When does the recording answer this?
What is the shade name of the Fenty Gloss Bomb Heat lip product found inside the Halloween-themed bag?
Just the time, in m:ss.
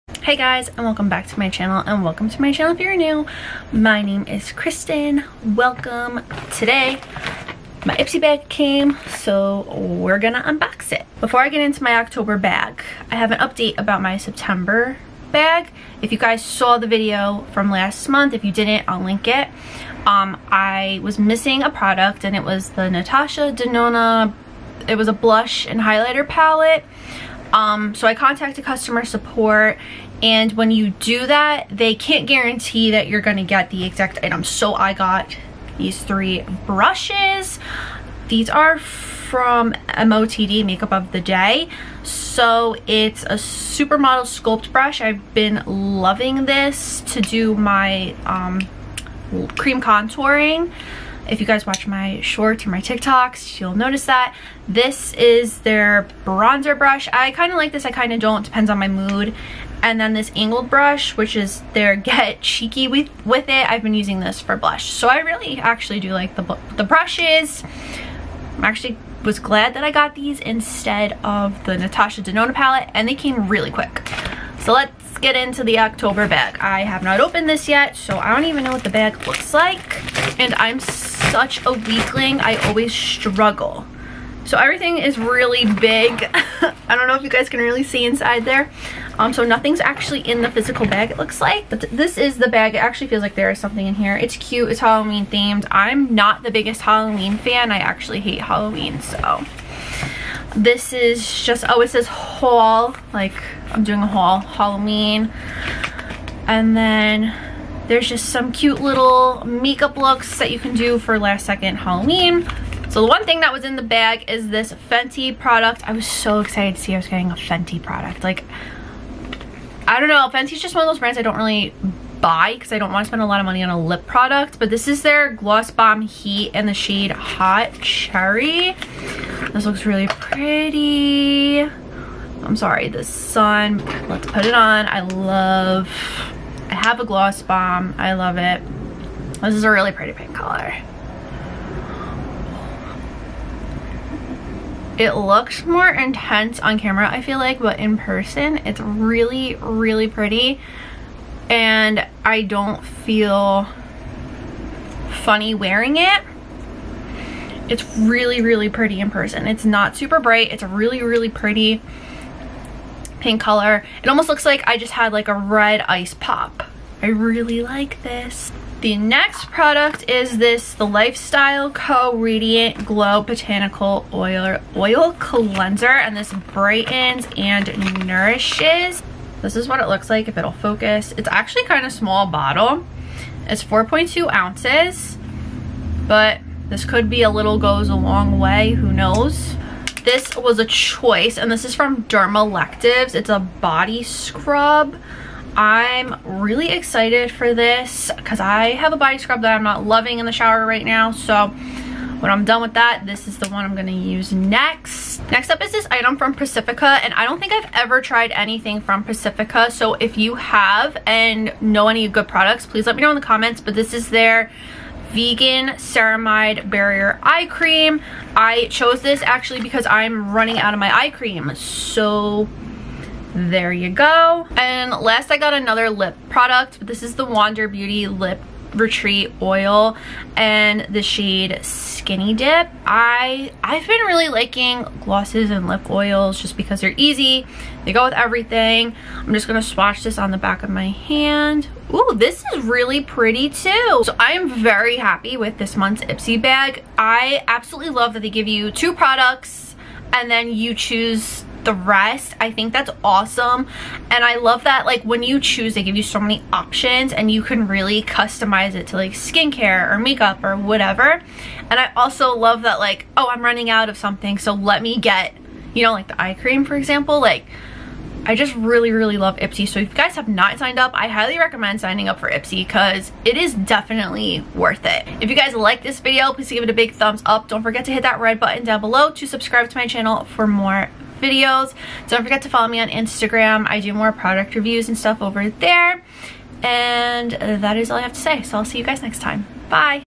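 2:07.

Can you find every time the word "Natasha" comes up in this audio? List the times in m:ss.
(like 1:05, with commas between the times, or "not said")
0:22, 1:11.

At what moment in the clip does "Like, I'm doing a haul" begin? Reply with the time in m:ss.
1:43.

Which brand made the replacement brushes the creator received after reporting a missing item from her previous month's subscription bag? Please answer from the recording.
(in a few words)
MOTD.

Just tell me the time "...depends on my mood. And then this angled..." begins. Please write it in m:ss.
0:58.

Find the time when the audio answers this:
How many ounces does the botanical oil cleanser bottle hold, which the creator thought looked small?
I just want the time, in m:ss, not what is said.
3:03.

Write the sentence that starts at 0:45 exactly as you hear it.
I've been loving this to do my um, cream contouring.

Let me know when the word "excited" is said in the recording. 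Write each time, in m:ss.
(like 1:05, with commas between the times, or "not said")
1:56, 3:16.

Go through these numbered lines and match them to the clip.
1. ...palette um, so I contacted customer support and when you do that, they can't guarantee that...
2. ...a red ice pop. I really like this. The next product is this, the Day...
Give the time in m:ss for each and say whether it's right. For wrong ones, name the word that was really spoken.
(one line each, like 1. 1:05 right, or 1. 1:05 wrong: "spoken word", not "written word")
1. 0:26 right
2. 2:45 wrong: "Lyfestyle", not "Day".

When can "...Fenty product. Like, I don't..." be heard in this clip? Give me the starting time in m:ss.
1:57.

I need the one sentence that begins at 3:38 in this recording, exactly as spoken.
I chose this actually because I'm running out of my eye cream.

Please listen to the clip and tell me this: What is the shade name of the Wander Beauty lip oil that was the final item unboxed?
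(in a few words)
Skinny Dip.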